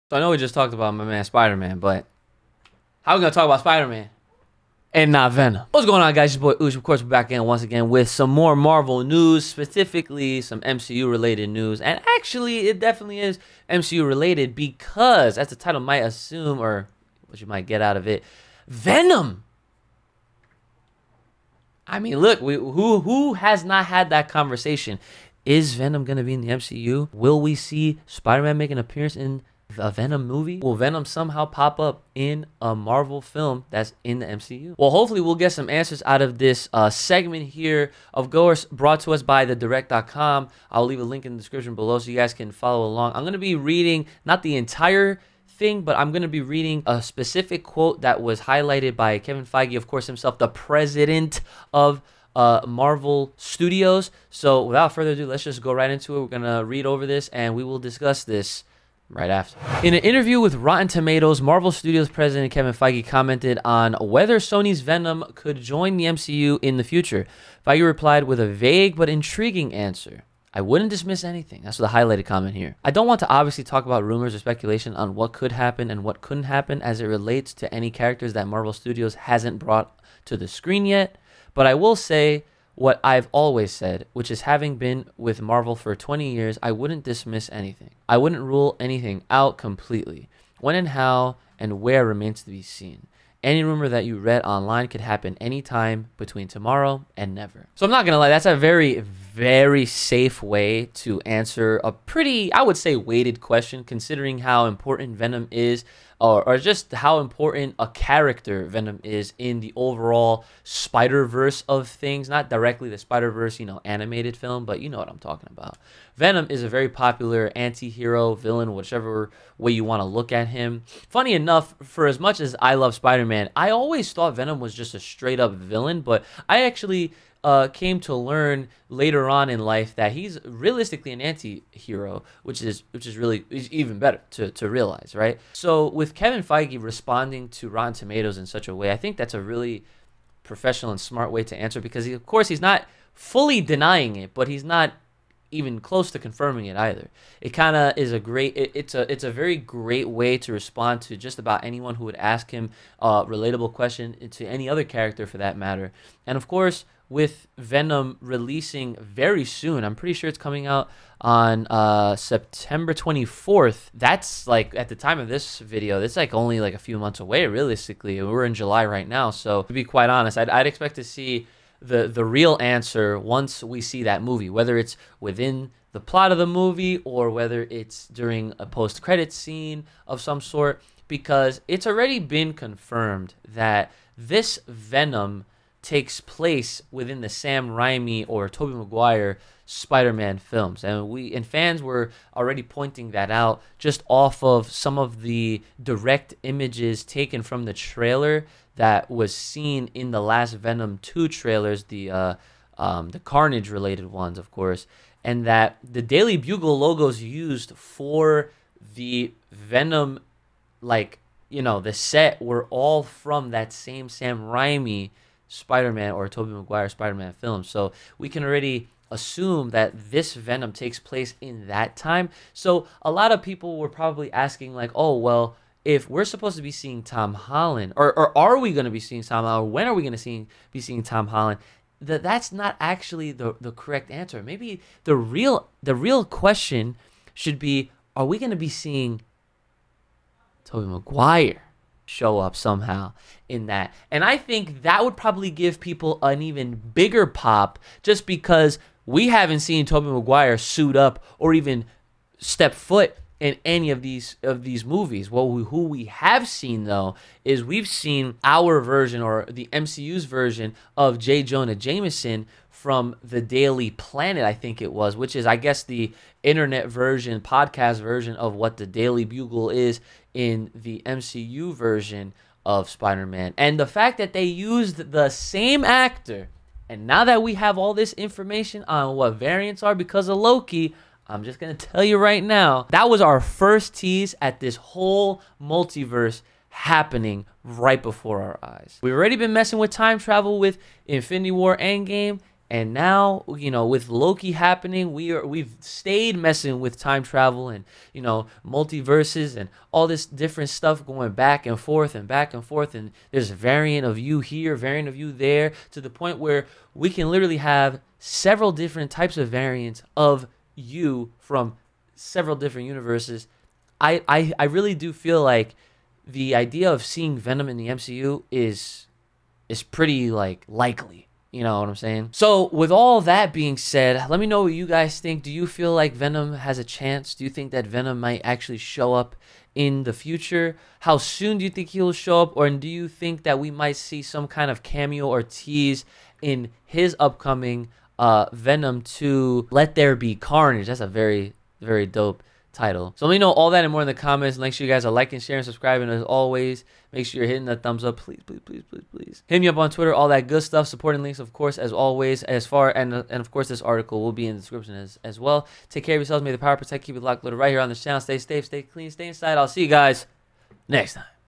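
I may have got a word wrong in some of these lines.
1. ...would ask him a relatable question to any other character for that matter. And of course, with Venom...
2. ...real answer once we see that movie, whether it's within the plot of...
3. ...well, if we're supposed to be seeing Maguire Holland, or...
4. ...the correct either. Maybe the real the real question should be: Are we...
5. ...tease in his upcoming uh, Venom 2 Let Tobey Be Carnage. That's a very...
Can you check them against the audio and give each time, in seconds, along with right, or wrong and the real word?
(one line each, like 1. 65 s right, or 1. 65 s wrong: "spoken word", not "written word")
1. 152 s right
2. 172 s right
3. 225 s wrong: "Tom", not "Maguire"
4. 233 s wrong: "answer", not "either"
5. 335 s wrong: "There", not "Tobey".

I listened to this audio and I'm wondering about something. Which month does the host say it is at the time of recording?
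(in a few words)
July.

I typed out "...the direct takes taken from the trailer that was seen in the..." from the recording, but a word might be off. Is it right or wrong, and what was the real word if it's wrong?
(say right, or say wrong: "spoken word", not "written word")
wrong: "images", not "takes".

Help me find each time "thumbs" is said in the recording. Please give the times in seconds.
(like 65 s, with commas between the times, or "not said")
347 s.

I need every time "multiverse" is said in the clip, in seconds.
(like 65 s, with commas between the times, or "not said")
285 s, 298 s.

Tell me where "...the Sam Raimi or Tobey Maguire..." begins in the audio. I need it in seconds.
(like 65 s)
187 s.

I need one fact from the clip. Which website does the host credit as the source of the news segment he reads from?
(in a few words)
thedirect.com.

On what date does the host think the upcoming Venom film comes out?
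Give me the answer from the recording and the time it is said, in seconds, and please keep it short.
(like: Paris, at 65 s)
September 24, at 162 s.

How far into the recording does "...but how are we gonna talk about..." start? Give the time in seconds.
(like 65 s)
1 s.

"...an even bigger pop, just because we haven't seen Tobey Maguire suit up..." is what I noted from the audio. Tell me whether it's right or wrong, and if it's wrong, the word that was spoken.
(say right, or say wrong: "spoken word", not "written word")
right.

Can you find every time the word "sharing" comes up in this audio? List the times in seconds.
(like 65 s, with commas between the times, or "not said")
345 s.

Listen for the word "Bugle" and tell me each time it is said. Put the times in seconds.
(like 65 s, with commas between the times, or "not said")
206 s, 269 s.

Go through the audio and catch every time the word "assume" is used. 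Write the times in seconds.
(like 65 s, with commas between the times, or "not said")
16 s, 219 s.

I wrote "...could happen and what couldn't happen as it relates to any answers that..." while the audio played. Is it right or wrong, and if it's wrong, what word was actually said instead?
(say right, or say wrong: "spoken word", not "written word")
wrong: "characters", not "answers".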